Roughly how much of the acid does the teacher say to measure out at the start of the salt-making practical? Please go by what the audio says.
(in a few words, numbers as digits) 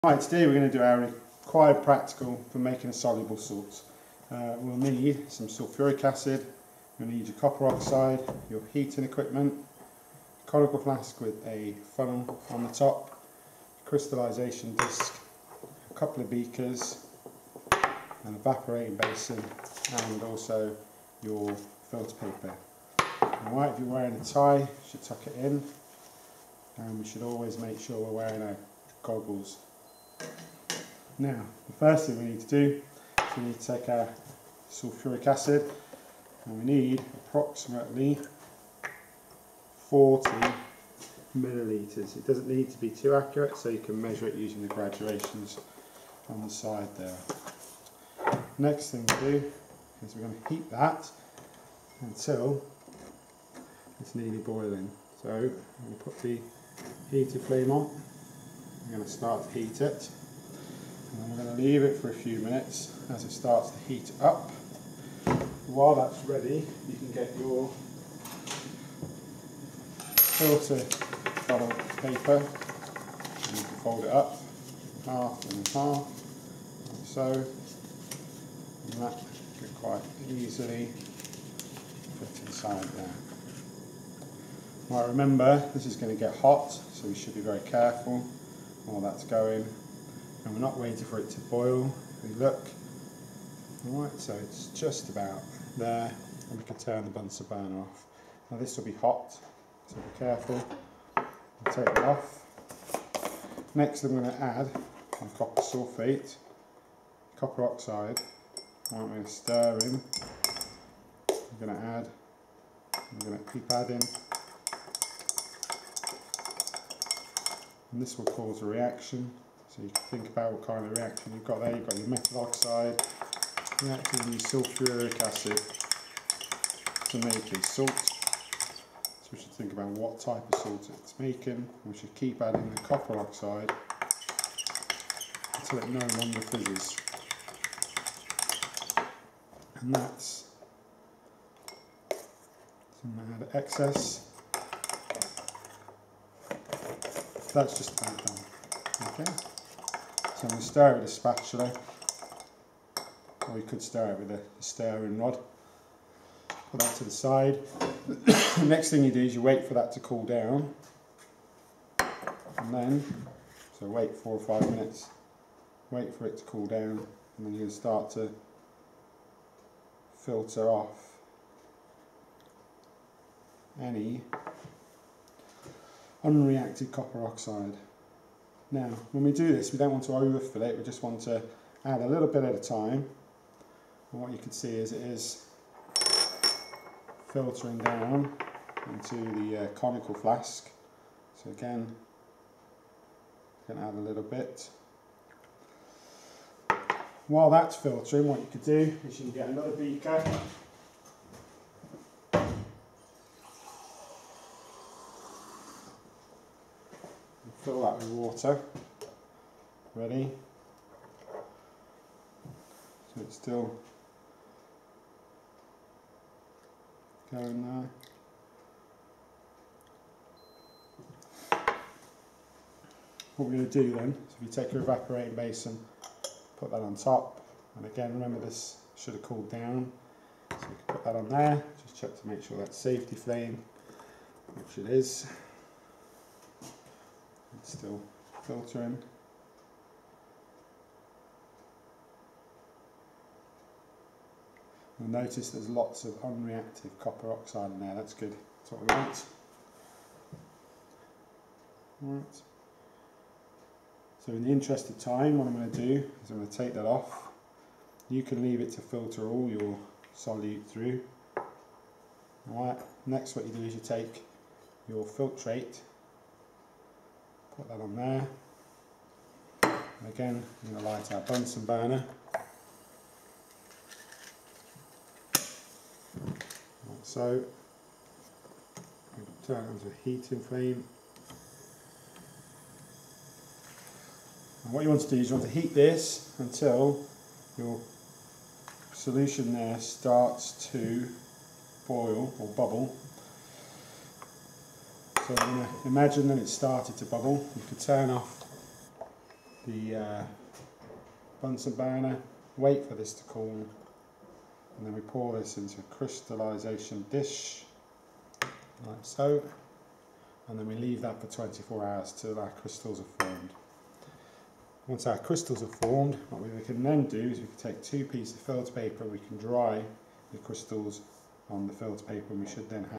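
40 millilitres.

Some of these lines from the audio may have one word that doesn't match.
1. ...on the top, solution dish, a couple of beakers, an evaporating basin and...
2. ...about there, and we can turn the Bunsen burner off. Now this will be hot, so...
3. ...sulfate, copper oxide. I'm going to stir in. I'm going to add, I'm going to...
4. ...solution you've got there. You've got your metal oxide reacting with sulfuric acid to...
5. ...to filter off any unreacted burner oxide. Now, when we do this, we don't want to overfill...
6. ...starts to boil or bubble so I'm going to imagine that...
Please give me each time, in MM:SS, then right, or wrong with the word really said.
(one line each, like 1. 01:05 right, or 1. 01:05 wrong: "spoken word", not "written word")
1. 00:12 wrong: "crystallisation", not "solution"
2. 01:35 right
3. 01:45 right
4. 02:00 wrong: "reaction", not "solution"
5. 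02:48 wrong: "copper", not "burner"
6. 04:49 right.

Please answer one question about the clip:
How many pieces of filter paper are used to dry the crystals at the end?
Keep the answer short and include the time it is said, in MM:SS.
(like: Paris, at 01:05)
2, at 05:17.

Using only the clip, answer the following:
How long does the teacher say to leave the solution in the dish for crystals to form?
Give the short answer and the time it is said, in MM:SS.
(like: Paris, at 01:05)
24 hours, at 05:11.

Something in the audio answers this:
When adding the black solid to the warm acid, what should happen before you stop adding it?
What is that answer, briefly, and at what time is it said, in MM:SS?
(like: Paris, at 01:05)
fizzes, at 02:15.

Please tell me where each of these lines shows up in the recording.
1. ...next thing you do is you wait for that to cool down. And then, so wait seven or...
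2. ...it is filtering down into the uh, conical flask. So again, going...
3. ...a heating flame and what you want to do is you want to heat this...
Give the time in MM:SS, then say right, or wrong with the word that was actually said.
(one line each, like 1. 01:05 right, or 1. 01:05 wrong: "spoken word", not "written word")
1. 02:38 wrong: "four", not "seven"
2. 03:04 right
3. 04:39 right.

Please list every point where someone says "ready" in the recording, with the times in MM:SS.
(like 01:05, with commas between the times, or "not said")
01:06, 03:29.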